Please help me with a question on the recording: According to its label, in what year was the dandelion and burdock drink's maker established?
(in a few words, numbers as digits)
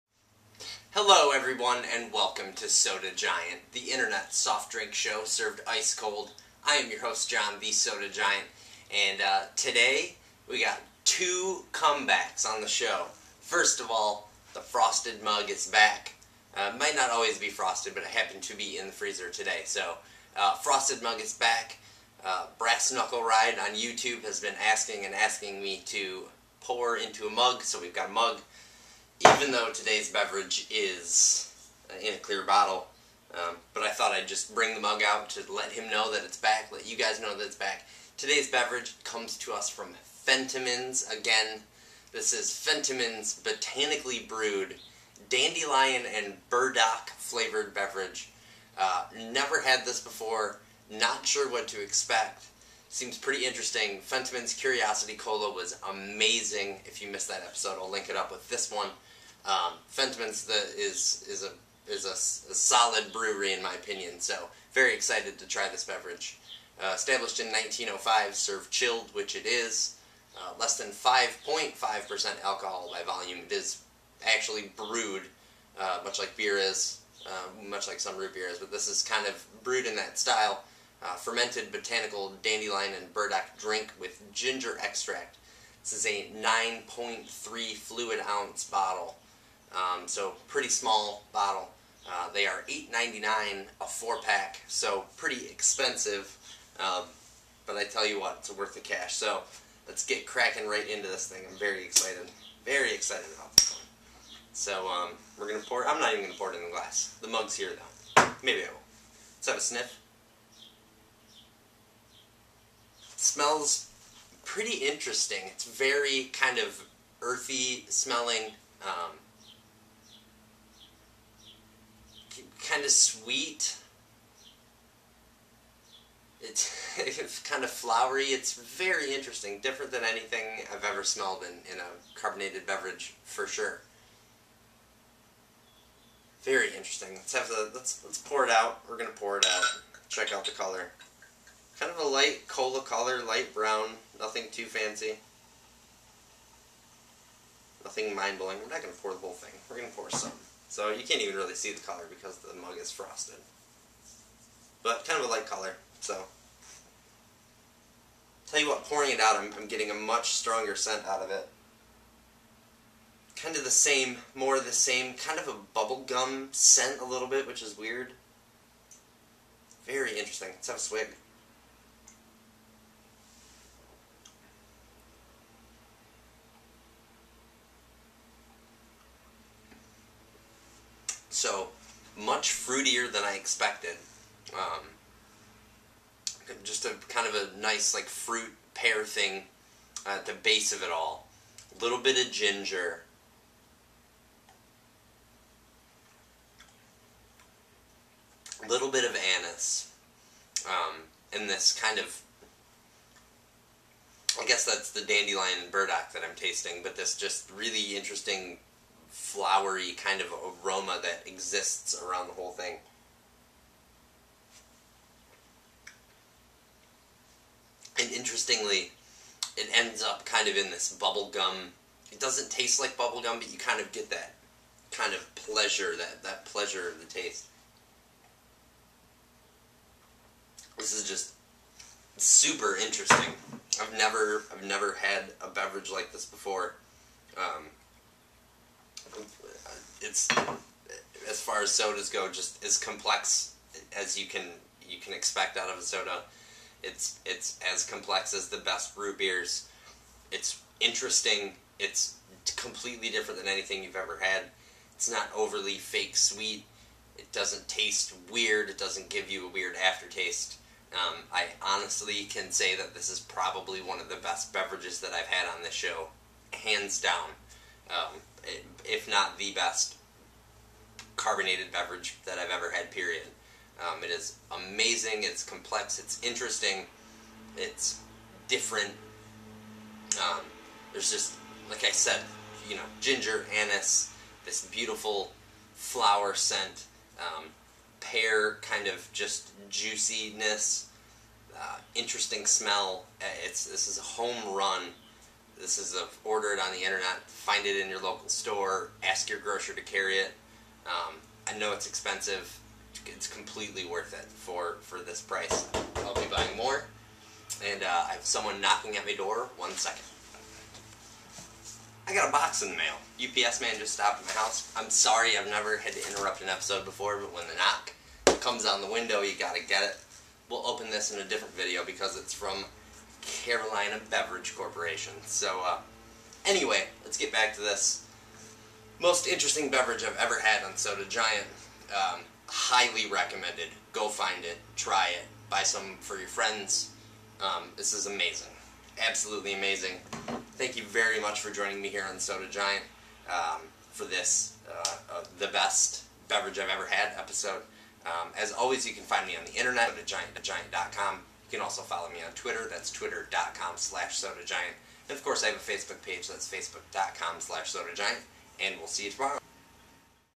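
1905.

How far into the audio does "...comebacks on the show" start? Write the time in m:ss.
0:11.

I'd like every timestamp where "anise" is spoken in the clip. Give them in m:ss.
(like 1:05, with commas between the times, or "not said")
3:19, 4:43.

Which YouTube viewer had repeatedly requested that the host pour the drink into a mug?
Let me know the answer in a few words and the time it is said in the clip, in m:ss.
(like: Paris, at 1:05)
Brass Knuckle Ride, at 0:22.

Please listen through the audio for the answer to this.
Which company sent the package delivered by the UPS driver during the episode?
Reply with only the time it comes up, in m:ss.
5:23.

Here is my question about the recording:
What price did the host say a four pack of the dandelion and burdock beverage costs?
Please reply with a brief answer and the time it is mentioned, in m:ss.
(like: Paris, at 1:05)
$8.99, at 1:32.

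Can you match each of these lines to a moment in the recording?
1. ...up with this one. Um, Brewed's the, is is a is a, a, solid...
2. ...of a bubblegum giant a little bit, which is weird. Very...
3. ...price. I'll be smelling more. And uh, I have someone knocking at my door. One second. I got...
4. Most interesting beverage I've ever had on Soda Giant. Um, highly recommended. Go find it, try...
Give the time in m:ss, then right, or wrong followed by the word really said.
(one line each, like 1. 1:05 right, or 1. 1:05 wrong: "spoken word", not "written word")
1. 0:58 wrong: "Fentiman", not "Brewed"
2. 2:45 wrong: "scent", not "giant"
3. 5:05 wrong: "buying", not "smelling"
4. 5:28 right.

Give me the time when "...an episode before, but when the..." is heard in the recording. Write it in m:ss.
5:16.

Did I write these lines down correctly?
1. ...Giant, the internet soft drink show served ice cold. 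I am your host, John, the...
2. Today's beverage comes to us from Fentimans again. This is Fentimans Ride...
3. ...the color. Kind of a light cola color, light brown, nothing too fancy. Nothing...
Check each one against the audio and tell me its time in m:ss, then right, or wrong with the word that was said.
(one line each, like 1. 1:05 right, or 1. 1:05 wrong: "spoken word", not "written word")
1. 0:03 right
2. 0:38 wrong: "Botanically", not "Ride"
3. 2:20 right.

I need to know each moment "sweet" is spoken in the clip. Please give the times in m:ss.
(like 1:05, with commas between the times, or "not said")
2:02, 4:16.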